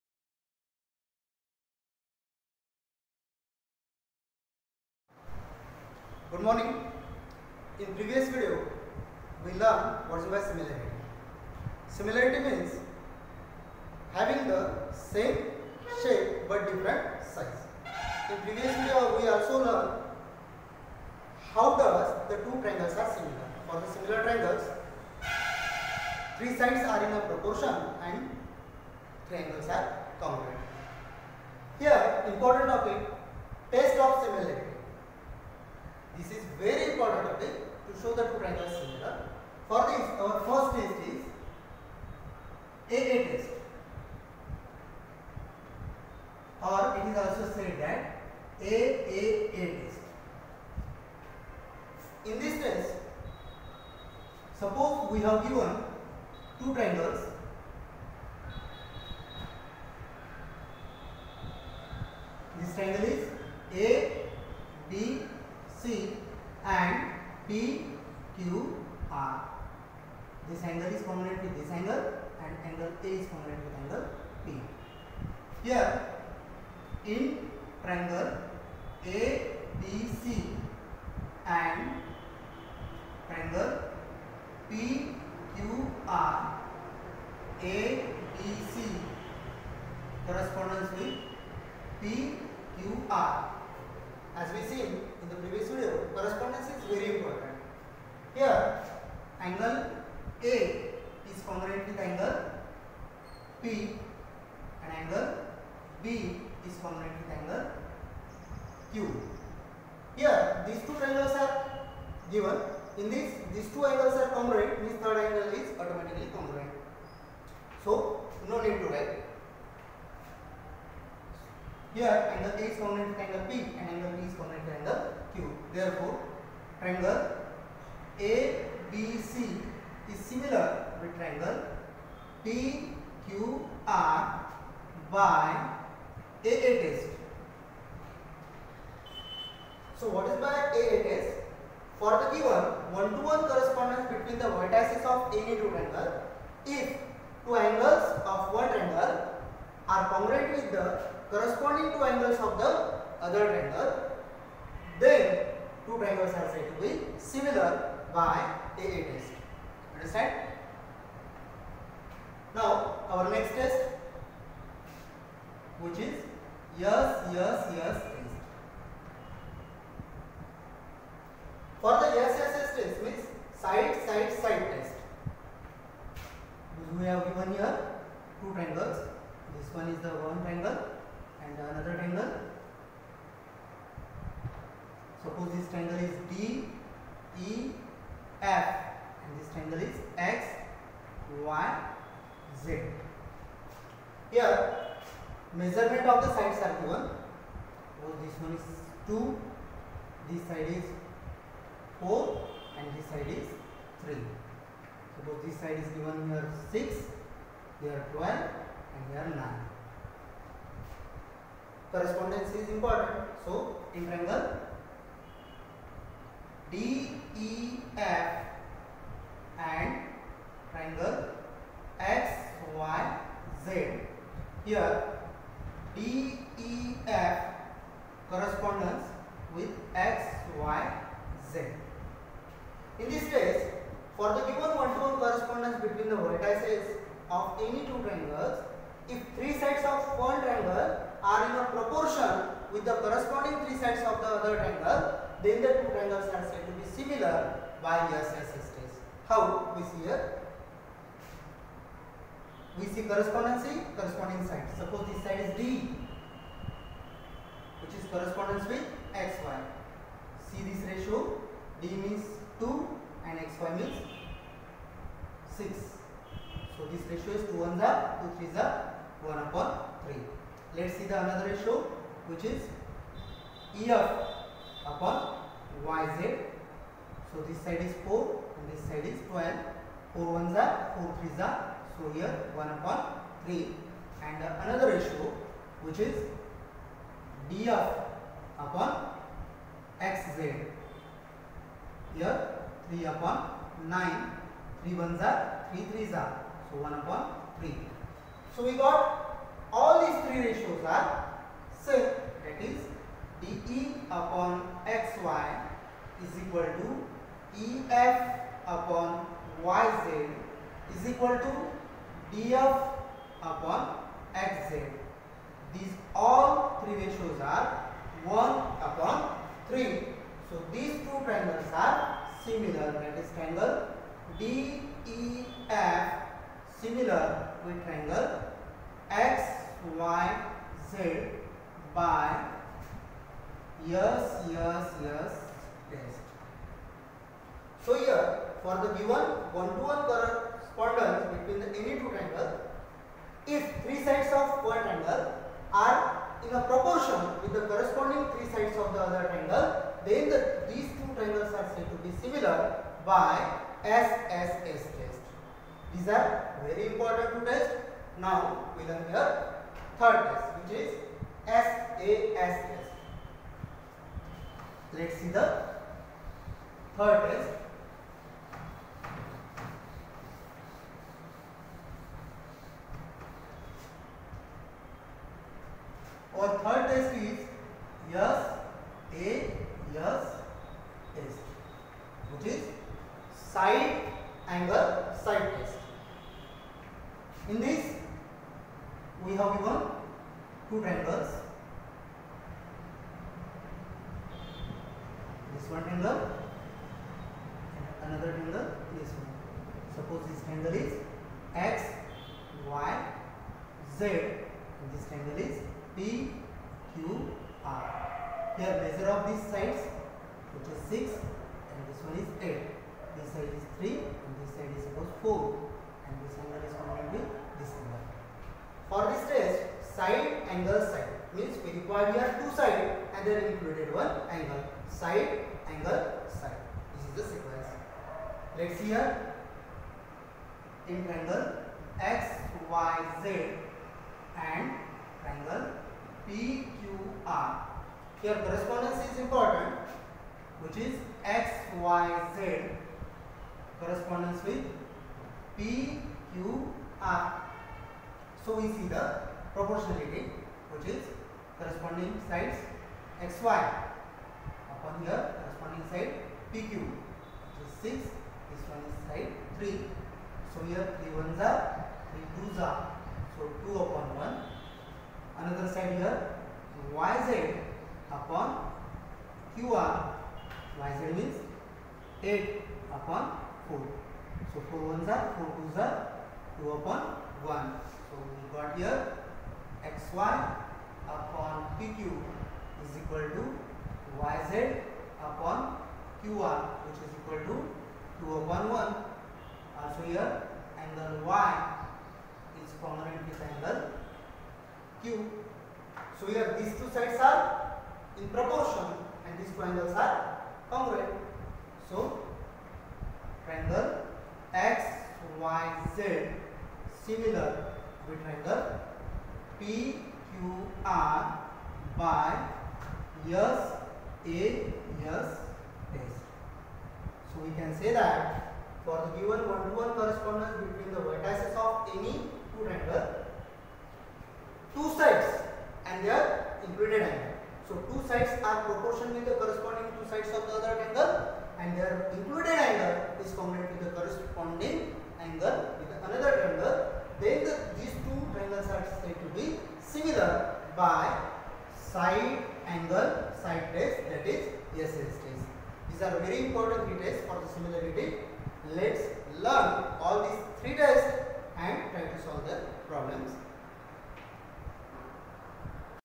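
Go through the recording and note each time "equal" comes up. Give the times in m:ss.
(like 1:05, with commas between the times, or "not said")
5:06, 5:11, 8:02, 8:07.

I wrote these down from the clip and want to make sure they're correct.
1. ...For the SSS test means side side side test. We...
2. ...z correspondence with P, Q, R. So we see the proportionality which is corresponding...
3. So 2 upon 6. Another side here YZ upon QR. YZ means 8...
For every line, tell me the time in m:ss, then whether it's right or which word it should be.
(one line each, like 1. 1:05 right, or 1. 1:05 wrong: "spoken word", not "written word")
1. 2:51 right
2. 7:22 right
3. 7:43 wrong: "1", not "6".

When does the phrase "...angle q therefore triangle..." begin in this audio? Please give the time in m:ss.
2:04.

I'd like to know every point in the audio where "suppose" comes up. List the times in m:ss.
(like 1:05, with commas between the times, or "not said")
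0:54, 3:05, 3:25, 4:14, 6:39, 6:54.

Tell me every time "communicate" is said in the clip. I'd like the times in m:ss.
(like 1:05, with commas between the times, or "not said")
not said.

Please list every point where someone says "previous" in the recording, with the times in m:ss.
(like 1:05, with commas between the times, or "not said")
0:07, 0:18, 1:35.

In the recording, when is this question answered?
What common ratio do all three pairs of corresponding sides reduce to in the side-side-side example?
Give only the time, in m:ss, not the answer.
5:18.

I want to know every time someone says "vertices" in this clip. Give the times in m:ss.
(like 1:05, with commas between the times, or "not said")
2:24, 3:56, 8:41.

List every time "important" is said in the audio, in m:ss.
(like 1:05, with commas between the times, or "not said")
0:32, 1:37, 3:32, 5:56, 7:19, 9:06.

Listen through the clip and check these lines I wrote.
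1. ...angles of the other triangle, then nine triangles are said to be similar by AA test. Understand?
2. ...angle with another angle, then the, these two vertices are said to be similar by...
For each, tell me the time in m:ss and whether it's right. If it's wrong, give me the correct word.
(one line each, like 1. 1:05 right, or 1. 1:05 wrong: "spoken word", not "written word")
1. 2:32 wrong: "two", not "nine"
2. 8:55 wrong: "triangles", not "vertices".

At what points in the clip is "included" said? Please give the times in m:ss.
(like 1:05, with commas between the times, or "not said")
7:03, 8:46, 8:52.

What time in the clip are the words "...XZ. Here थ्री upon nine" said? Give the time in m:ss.
4:50.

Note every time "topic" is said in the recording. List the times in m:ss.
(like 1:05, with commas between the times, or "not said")
0:32.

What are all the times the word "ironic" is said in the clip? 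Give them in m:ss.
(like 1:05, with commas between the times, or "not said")
not said.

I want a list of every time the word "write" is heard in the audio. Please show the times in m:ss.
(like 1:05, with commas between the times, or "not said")
1:58.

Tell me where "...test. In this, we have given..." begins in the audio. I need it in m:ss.
6:25.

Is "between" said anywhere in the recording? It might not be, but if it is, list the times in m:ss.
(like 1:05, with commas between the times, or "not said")
2:24, 3:55, 5:41, 8:40.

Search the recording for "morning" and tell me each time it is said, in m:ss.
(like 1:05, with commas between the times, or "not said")
0:06.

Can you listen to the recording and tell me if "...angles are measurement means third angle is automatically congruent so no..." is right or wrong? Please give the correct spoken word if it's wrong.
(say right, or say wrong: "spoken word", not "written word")
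wrong: "congruent", not "measurement".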